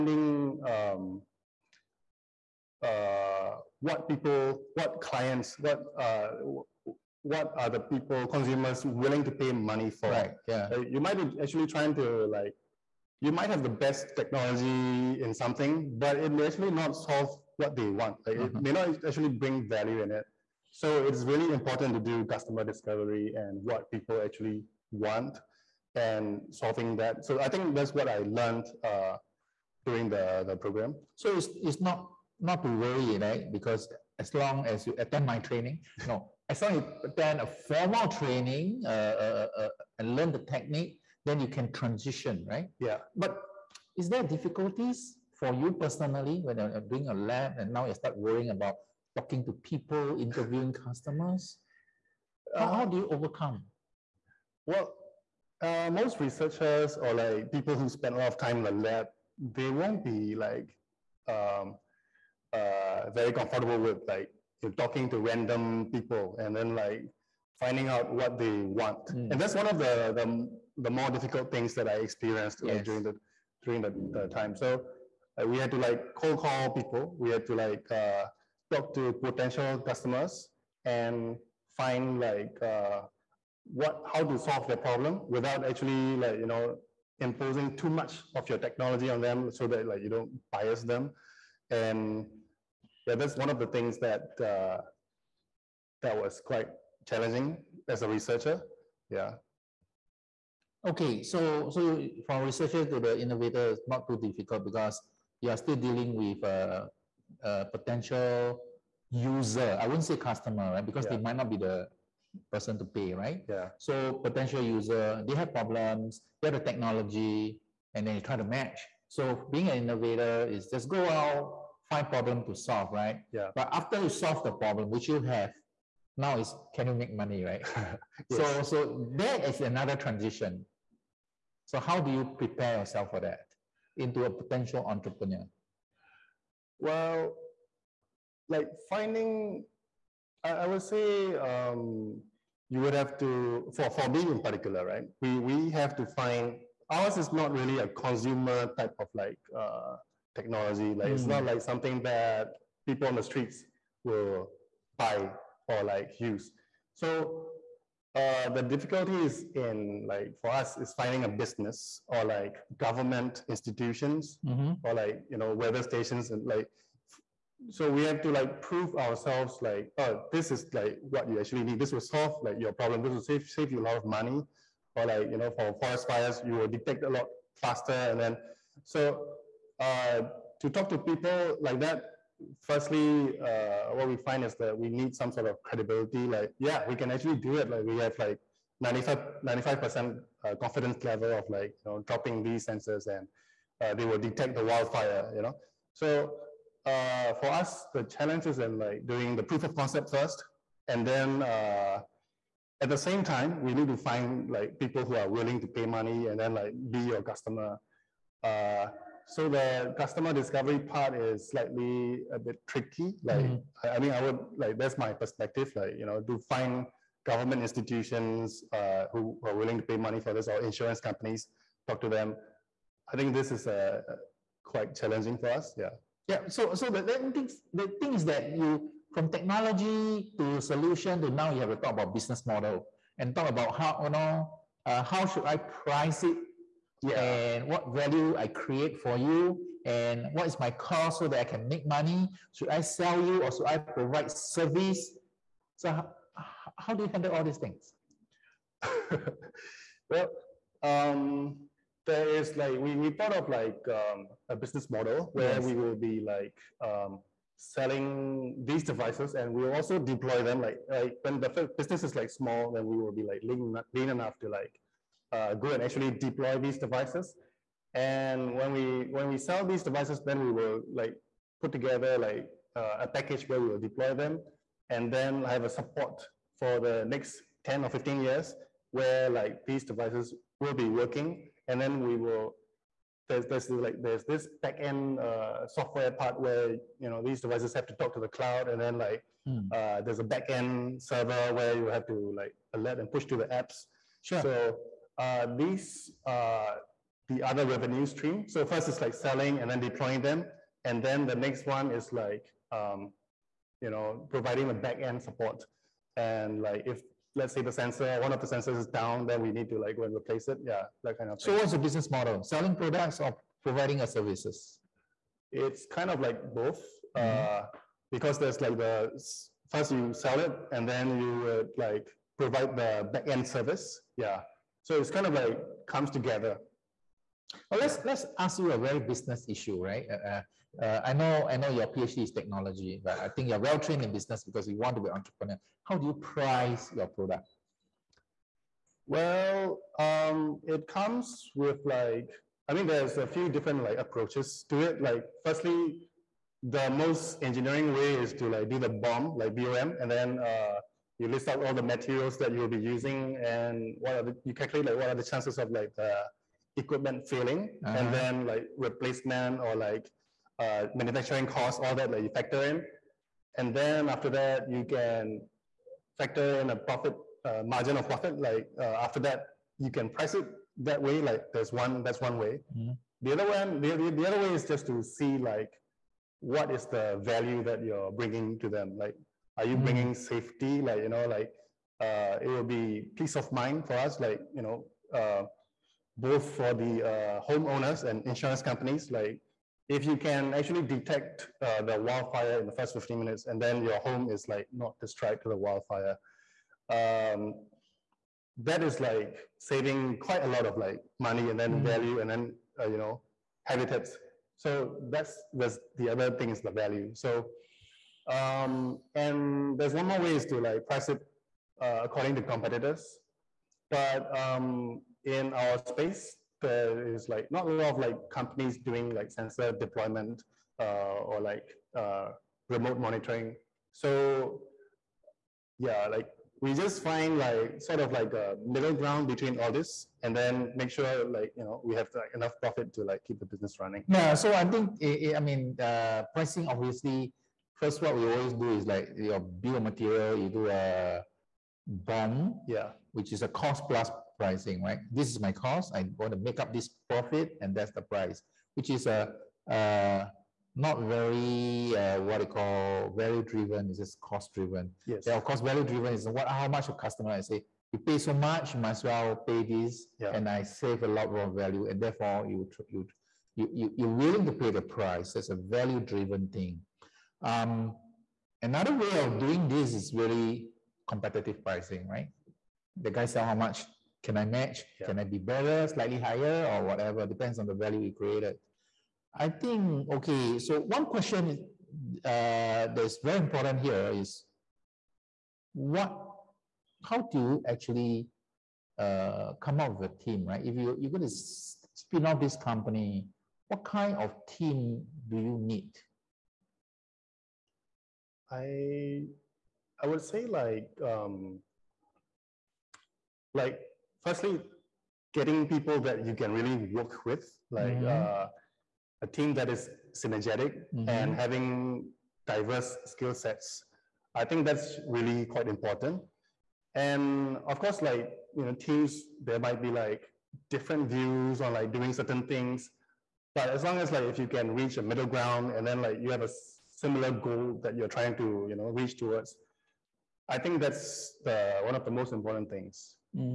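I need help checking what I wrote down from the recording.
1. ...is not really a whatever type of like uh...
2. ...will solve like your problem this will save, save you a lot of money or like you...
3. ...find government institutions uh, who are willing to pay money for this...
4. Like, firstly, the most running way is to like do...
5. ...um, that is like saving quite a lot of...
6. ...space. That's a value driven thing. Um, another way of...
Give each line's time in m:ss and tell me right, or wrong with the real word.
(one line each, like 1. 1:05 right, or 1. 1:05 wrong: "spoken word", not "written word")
1. 2:27 wrong: "consumer", not "whatever"
2. 2:51 right
3. 3:36 right
4. 5:45 wrong: "engineering", not "running"
5. 6:36 right
6. 7:44 wrong: "price", not "space".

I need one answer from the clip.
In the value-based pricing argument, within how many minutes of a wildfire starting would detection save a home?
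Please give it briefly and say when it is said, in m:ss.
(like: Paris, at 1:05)
15, at 6:32.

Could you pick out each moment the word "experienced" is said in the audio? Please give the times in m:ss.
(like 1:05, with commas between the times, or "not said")
1:11.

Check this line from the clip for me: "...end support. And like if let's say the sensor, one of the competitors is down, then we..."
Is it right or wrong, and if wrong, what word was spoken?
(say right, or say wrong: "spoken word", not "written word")
wrong: "sensors", not "competitors".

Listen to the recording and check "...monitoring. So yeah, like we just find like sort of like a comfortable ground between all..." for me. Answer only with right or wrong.
wrong.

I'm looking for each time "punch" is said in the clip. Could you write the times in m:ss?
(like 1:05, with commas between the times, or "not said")
not said.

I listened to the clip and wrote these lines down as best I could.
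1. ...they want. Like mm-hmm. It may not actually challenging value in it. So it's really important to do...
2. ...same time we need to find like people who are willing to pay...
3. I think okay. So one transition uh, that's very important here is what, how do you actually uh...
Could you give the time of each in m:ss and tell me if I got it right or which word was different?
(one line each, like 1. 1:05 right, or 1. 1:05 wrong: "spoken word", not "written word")
1. 0:17 wrong: "bring", not "challenging"
2. 3:22 right
3. 7:59 wrong: "question", not "transition".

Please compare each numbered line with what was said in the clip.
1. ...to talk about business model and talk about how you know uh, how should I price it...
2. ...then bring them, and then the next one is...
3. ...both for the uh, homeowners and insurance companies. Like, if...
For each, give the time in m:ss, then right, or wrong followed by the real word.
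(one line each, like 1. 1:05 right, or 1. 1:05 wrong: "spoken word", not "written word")
1. 3:51 right
2. 4:59 wrong: "deploying", not "bring"
3. 6:26 right.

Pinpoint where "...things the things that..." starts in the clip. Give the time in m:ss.
3:47.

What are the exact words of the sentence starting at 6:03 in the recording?
And then after that, you can factor in a profit uh, margin of profit.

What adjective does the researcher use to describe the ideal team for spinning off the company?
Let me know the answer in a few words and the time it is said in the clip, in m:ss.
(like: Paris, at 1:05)
synergetic, at 8:30.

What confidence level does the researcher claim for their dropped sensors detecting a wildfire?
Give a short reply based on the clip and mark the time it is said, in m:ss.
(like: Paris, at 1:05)
95 percent, at 3:08.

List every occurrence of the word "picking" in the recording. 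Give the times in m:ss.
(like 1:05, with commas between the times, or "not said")
not said.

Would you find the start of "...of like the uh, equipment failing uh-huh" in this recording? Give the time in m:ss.
5:55.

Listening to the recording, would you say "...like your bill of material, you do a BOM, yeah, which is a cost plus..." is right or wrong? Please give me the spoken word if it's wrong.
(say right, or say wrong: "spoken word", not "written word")
right.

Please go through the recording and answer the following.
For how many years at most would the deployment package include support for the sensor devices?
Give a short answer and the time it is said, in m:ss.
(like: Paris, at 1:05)
15, at 4:37.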